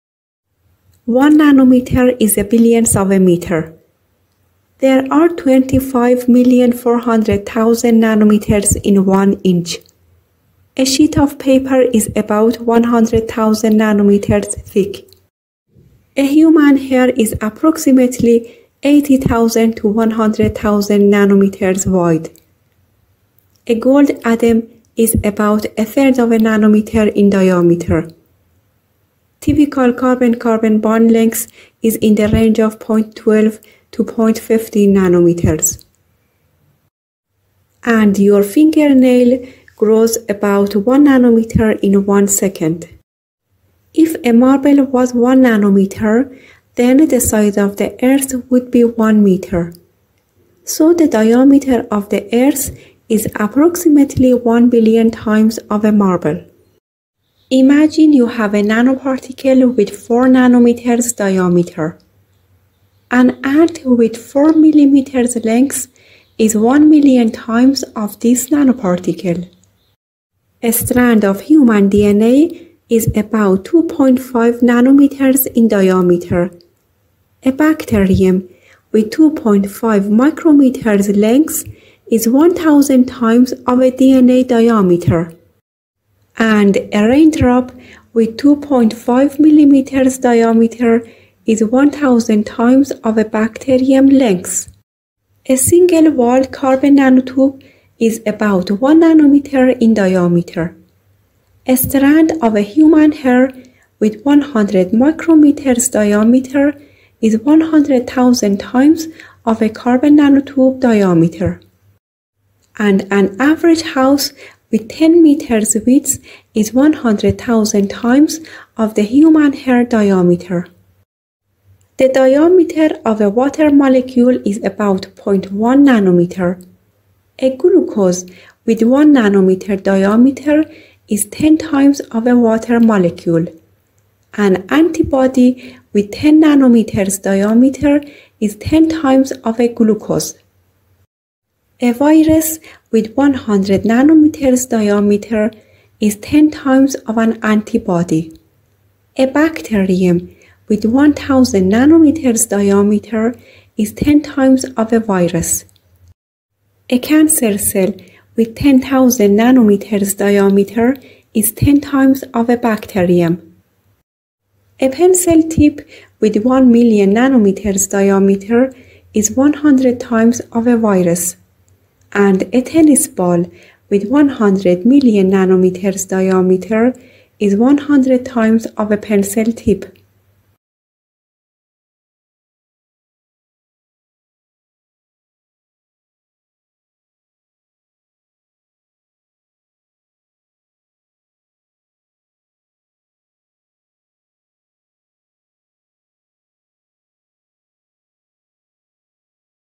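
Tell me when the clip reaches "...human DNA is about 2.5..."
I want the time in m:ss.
1:11.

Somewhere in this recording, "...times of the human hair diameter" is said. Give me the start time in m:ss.
1:57.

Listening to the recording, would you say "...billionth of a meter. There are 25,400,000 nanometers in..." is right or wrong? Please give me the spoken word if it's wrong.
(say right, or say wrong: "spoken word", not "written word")
right.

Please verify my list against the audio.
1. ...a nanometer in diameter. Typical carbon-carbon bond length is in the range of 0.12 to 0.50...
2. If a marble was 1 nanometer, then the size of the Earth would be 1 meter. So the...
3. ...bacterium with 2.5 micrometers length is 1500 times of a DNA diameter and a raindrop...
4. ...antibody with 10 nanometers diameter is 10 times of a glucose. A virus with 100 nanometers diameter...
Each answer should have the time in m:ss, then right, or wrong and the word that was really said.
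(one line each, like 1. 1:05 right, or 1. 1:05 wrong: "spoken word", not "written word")
1. 0:26 right
2. 0:43 right
3. 1:17 wrong: "1000", not "1500"
4. 2:14 right.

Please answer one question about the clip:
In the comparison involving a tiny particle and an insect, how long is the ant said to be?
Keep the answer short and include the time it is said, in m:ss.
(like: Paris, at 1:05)
4 millimeters, at 1:04.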